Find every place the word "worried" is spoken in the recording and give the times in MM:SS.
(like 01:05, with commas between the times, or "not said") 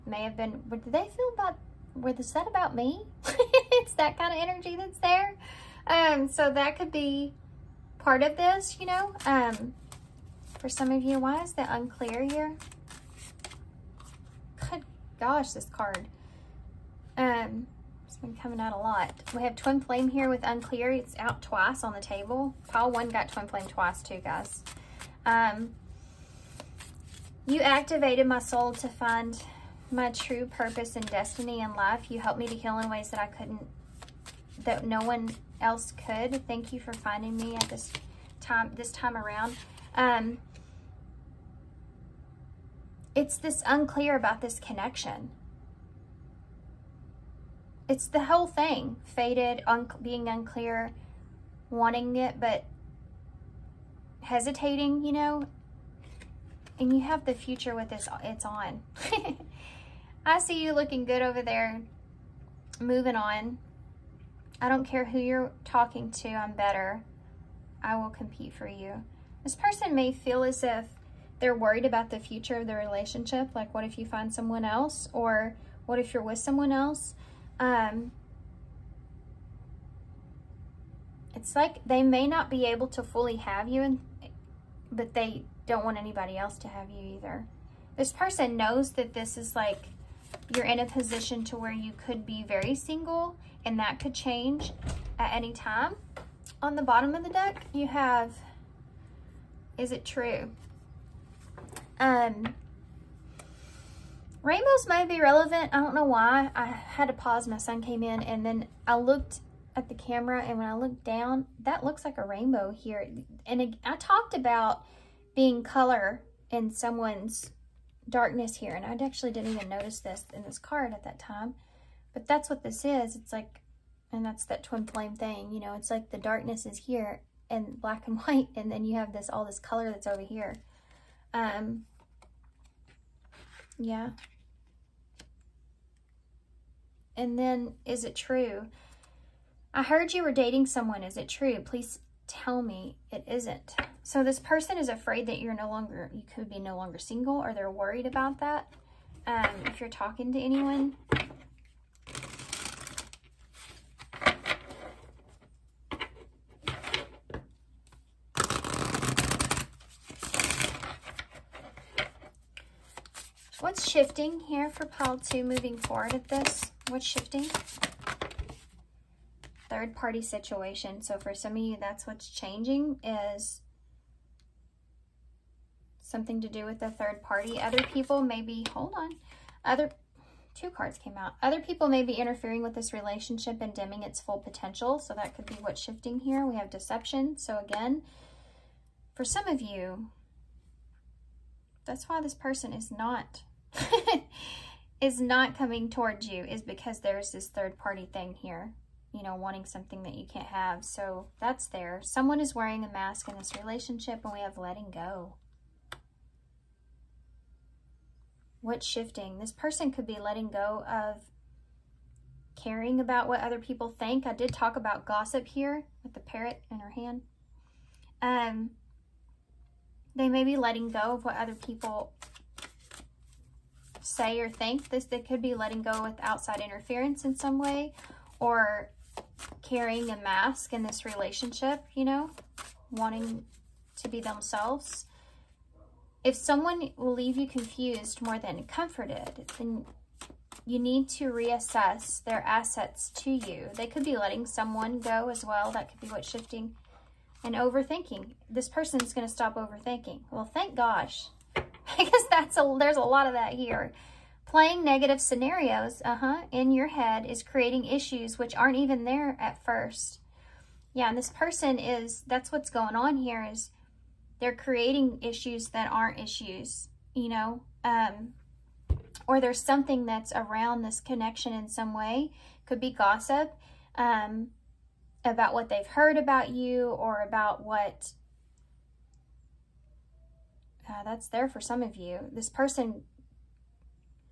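01:11, 02:27.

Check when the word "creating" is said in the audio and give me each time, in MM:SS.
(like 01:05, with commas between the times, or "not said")
04:17, 04:24.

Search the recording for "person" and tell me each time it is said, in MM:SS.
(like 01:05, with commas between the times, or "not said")
01:09, 01:28, 02:24, 03:12, 03:29, 04:08, 04:21, 04:42.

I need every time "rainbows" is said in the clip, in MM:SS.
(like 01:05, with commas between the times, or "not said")
01:44, 01:52.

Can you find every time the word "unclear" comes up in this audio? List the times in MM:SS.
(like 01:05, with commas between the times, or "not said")
00:11, 00:20, 00:43, 00:50.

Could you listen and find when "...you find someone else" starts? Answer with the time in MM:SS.
01:13.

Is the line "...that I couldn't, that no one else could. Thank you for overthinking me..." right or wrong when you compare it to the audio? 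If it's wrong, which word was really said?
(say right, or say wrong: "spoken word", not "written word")
wrong: "finding", not "overthinking".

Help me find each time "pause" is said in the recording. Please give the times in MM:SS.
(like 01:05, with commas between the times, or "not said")
01:47.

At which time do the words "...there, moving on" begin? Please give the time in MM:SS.
01:01.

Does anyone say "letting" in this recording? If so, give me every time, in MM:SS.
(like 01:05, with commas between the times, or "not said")
03:24, 03:30, 03:40, 03:45, 04:04.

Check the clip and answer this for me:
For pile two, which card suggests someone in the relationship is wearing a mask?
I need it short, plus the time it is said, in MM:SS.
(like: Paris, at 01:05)
Deception, at 03:06.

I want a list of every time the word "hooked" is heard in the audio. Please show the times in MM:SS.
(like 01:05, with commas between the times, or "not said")
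not said.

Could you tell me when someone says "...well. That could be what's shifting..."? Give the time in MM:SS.
04:05.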